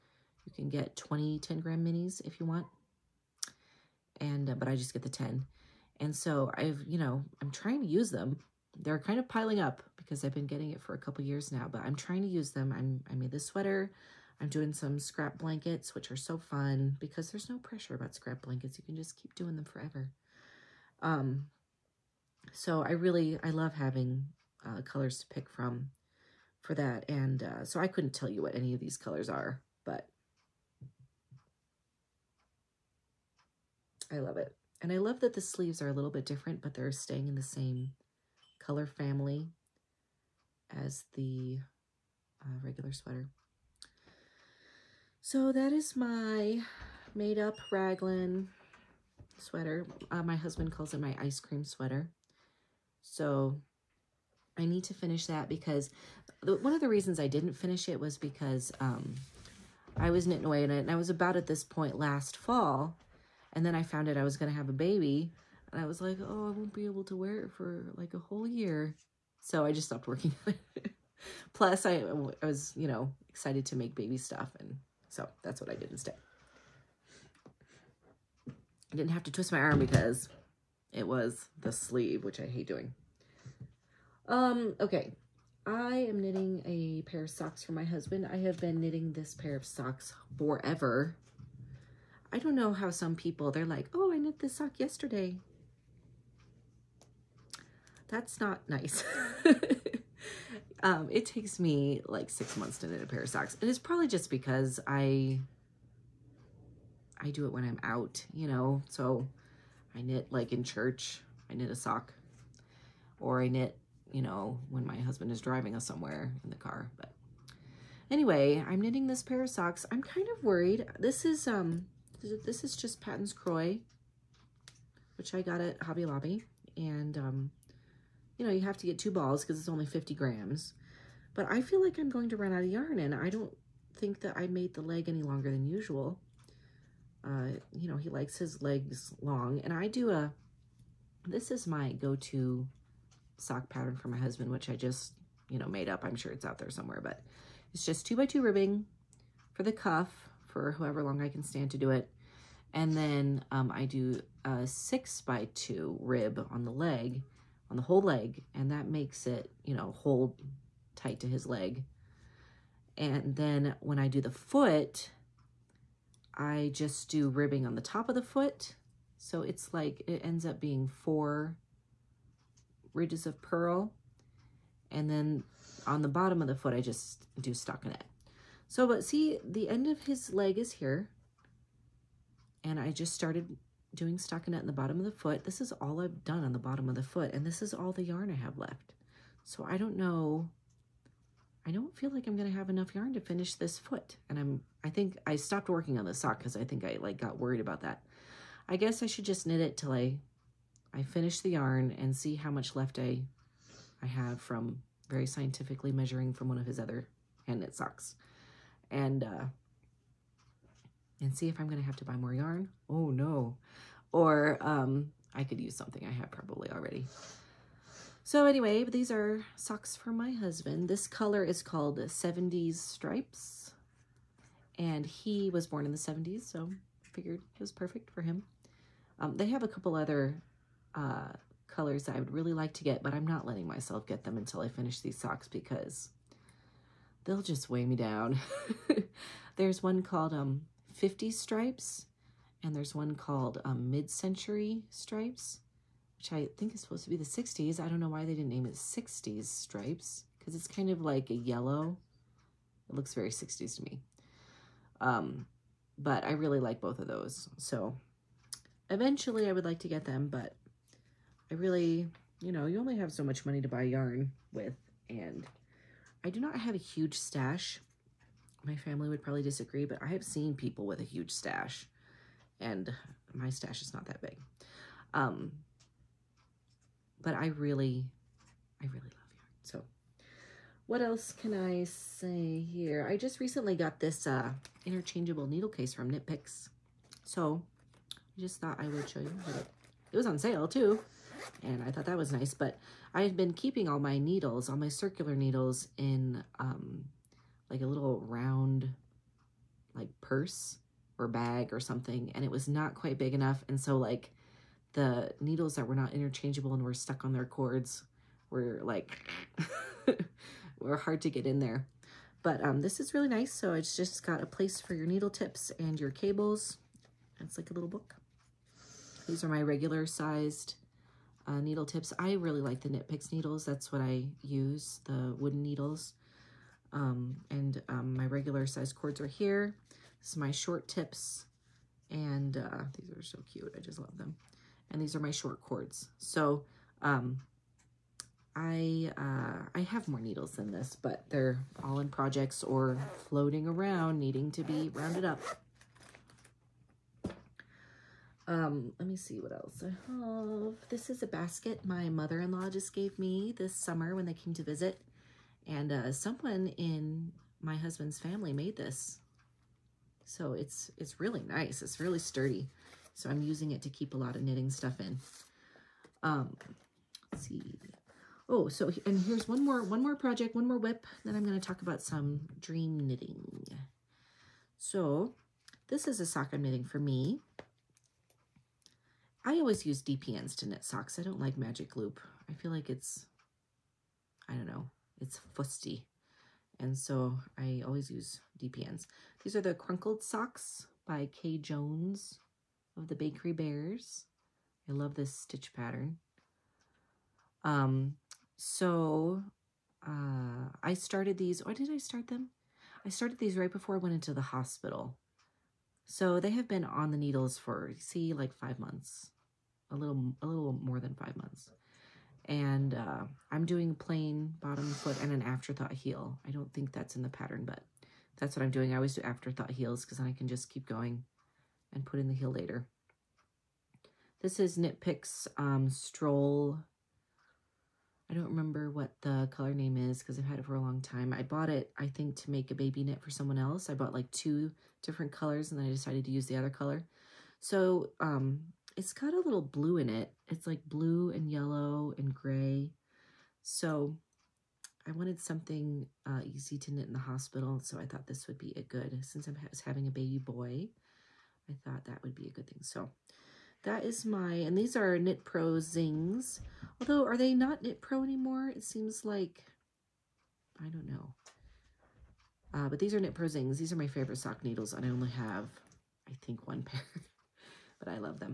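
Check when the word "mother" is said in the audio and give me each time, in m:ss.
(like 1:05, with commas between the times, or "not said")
5:52.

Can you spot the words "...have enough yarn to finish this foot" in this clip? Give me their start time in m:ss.
3:12.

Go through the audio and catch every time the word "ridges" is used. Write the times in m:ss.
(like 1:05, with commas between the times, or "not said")
2:52.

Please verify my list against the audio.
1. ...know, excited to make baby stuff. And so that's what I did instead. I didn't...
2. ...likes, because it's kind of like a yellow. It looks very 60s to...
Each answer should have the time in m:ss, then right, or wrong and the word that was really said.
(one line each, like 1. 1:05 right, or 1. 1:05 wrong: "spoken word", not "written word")
1. 1:12 right
2. 4:09 wrong: "stripes", not "likes".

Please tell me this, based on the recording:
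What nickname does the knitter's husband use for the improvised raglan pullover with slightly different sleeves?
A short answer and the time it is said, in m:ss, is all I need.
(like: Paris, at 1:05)
ice cream sweater, at 0:51.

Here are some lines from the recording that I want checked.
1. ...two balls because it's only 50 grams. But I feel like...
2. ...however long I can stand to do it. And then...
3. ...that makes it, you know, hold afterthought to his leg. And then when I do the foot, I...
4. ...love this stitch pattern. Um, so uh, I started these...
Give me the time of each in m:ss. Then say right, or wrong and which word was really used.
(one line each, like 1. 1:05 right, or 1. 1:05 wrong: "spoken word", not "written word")
1. 2:08 right
2. 2:30 right
3. 2:38 wrong: "tight", not "afterthought"
4. 6:34 right.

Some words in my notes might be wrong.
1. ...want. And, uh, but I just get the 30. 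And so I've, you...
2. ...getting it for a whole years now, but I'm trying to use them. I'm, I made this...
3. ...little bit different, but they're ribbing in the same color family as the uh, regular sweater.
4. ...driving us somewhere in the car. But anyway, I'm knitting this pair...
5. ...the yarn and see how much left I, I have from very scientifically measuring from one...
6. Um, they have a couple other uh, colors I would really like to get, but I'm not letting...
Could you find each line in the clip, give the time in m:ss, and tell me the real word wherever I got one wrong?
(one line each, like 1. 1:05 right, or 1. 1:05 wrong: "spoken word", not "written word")
1. 0:02 wrong: "10", not "30"
2. 0:10 wrong: "couple", not "whole"
3. 0:35 wrong: "staying", not "ribbing"
4. 1:55 right
5. 3:21 right
6. 3:49 right.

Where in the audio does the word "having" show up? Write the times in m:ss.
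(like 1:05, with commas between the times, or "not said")
0:23, 7:29.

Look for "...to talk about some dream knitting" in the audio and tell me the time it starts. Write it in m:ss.
6:11.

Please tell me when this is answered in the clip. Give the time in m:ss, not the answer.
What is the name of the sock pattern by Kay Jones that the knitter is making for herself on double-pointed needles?
6:29.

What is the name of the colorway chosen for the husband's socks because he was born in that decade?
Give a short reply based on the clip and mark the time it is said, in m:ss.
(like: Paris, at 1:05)
70s Stripes, at 3:41.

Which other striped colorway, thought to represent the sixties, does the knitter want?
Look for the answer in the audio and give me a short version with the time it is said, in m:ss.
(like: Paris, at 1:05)
mid-century stripes, at 4:03.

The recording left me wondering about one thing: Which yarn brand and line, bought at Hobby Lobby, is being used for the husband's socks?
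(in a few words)
Patons Kroy.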